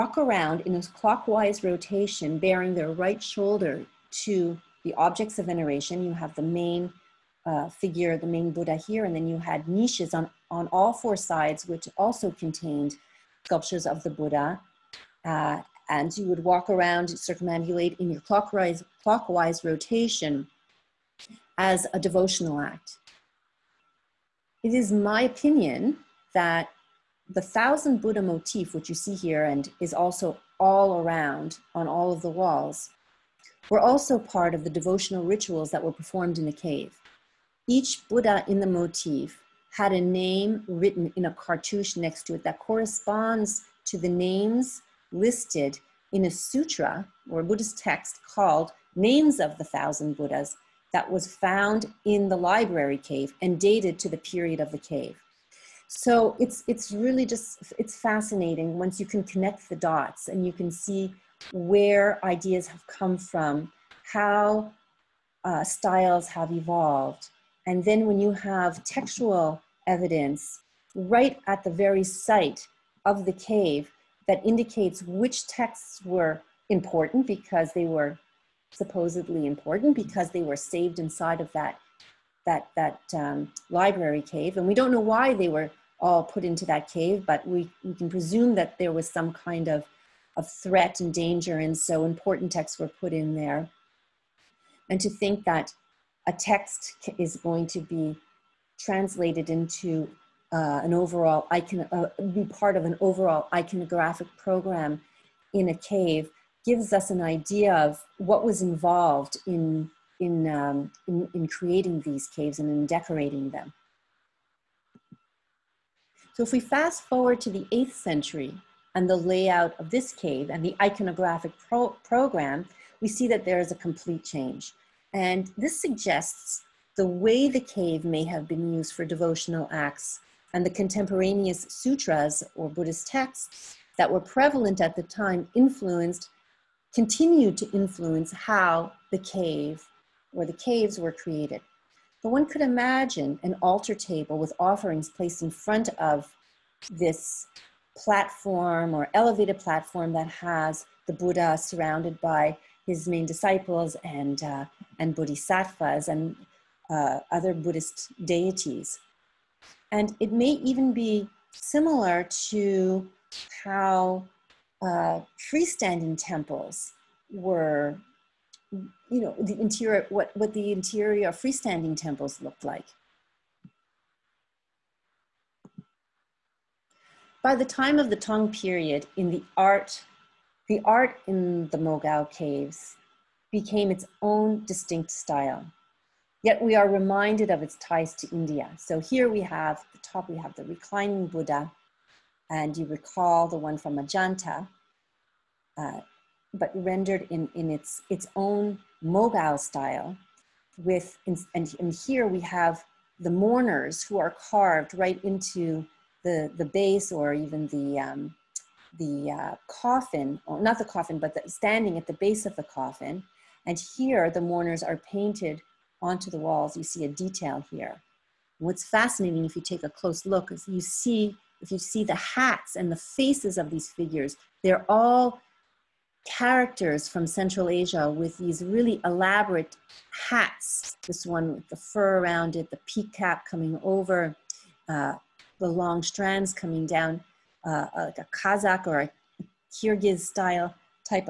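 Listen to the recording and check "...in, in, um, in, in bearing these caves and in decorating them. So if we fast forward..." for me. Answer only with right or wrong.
wrong.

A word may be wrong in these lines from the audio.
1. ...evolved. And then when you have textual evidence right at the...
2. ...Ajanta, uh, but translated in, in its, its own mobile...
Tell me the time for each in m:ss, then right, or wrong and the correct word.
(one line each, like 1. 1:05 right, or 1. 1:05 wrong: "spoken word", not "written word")
1. 1:06 right
2. 3:13 wrong: "rendered", not "translated".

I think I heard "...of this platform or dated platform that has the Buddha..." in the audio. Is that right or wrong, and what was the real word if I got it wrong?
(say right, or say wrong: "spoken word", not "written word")
wrong: "elevated", not "dated".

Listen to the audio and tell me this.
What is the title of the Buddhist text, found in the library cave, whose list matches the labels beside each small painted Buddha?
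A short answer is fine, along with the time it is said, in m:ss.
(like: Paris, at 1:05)
Names of the Thousand Buddhas, at 0:48.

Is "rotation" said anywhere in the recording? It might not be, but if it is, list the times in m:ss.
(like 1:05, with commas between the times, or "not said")
0:01, 0:19.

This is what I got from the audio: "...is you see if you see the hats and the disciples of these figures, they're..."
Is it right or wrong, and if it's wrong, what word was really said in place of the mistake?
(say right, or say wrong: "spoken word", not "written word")
wrong: "faces", not "disciples".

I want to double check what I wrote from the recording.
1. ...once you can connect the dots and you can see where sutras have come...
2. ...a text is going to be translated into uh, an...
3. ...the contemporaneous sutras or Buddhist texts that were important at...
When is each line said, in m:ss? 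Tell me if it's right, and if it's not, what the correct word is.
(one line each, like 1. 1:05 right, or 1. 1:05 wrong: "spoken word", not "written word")
1. 0:58 wrong: "ideas", not "sutras"
2. 1:36 right
3. 2:10 wrong: "prevalent", not "important".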